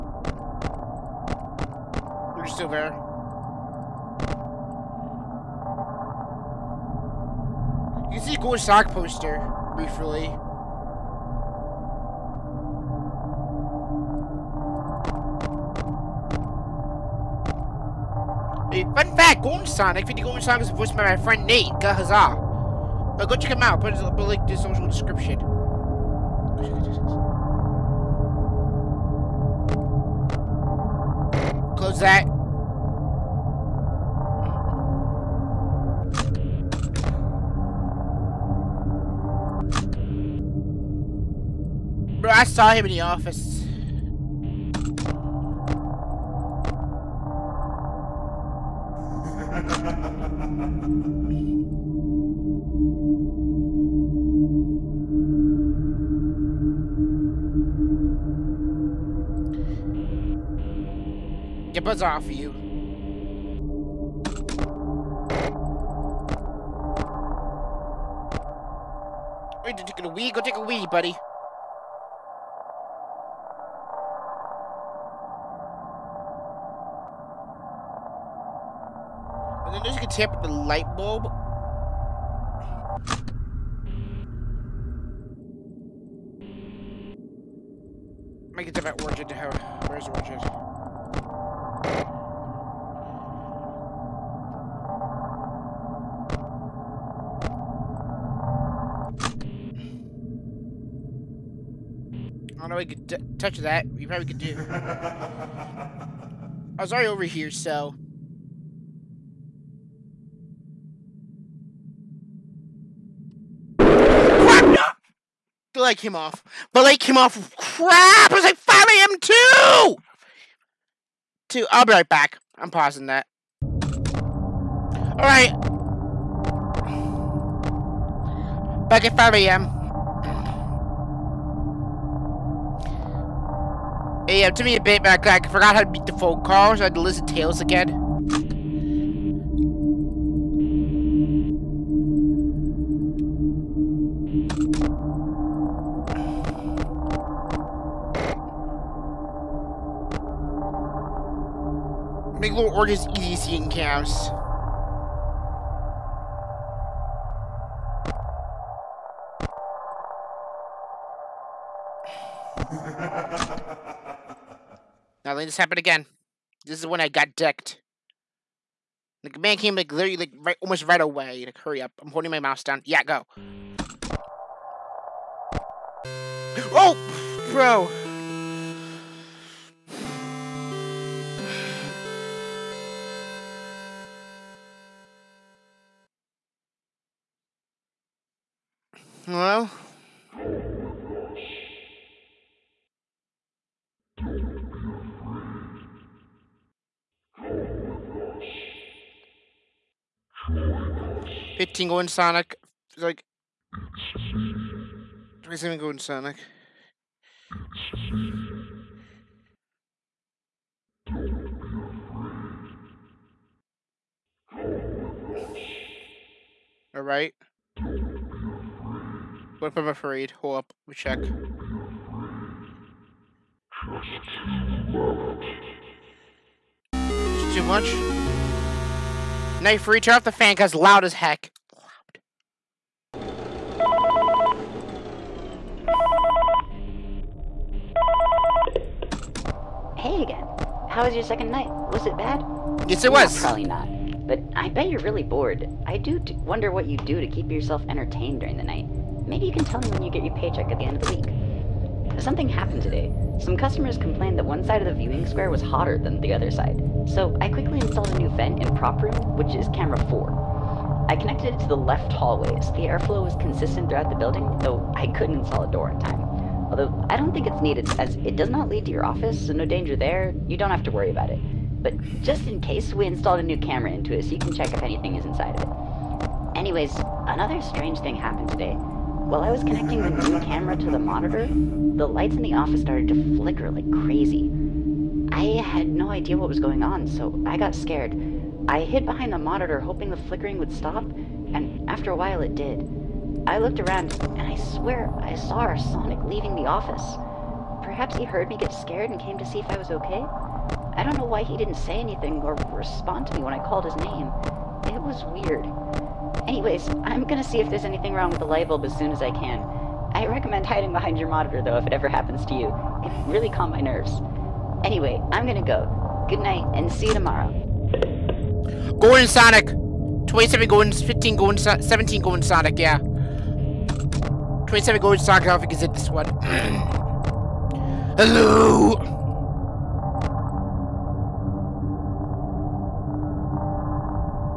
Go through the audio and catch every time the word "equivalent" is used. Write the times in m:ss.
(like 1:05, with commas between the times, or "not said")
not said.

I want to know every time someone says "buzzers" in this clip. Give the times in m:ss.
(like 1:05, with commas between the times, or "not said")
1:01.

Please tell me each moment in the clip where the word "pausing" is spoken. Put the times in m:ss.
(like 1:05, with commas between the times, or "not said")
2:02.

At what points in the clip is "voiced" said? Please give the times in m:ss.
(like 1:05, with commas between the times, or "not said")
0:20.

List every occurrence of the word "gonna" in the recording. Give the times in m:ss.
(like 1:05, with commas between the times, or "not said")
5:07, 5:15.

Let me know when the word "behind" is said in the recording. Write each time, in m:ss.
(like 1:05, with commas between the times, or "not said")
4:49, 5:10.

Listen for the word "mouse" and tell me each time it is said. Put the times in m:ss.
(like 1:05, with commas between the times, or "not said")
2:52.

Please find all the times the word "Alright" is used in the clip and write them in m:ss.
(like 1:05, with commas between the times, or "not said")
2:04, 3:36.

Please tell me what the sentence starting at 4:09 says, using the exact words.
Maybe you can tell me when you get your paycheck at the end of the week.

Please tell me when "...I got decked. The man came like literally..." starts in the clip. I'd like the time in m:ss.
2:46.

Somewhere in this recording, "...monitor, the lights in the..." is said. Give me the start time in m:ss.
4:40.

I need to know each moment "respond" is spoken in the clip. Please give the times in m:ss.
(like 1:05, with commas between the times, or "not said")
5:02.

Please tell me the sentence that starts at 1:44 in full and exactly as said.
I was already over here, so.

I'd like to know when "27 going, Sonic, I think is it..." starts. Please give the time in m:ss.
5:24.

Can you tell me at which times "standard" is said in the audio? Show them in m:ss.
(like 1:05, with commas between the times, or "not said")
not said.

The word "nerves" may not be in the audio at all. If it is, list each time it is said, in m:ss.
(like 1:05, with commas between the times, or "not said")
5:13.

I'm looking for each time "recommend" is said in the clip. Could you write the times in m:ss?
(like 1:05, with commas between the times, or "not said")
5:10.